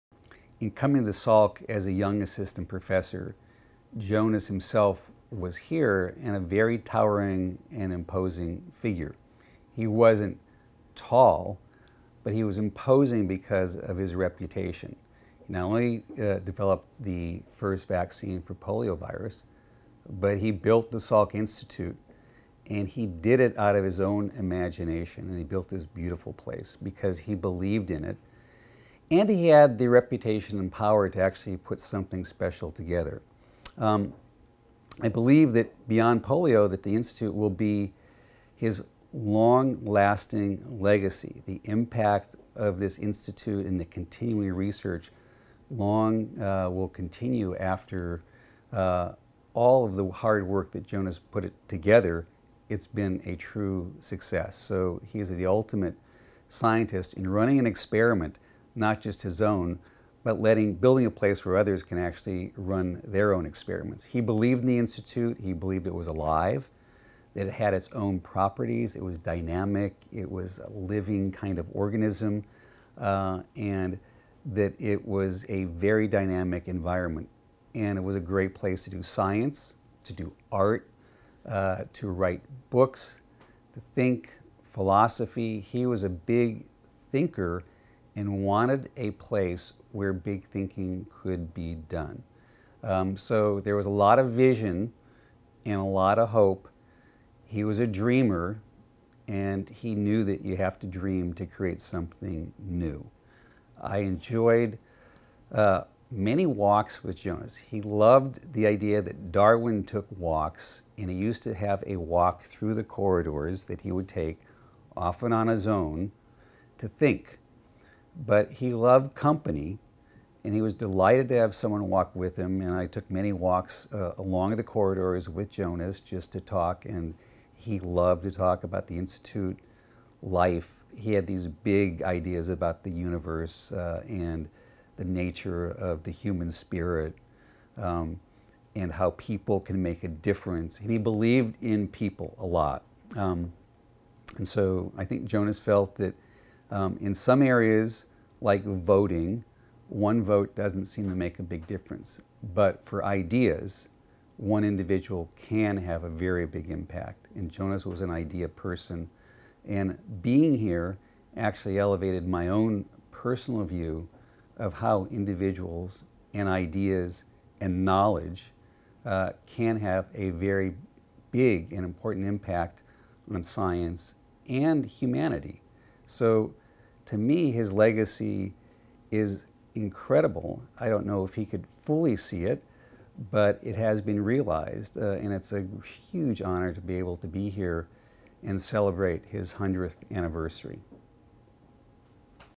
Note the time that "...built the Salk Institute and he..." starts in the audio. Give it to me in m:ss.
0:20.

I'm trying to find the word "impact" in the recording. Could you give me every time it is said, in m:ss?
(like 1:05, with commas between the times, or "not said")
0:41, 2:36, 2:52.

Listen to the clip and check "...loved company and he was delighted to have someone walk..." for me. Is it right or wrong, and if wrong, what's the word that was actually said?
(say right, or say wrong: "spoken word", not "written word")
right.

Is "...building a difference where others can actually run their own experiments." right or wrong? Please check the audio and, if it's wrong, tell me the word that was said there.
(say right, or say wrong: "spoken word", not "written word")
wrong: "place", not "difference".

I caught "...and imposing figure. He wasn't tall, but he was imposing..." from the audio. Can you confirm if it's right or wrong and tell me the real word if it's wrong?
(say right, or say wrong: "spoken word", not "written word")
right.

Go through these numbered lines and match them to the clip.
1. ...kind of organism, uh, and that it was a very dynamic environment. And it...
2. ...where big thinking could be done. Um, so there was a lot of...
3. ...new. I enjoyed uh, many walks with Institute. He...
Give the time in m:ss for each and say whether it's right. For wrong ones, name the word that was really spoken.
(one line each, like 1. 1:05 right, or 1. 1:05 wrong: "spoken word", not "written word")
1. 1:11 right
2. 1:29 right
3. 1:42 wrong: "Jonas", not "Institute".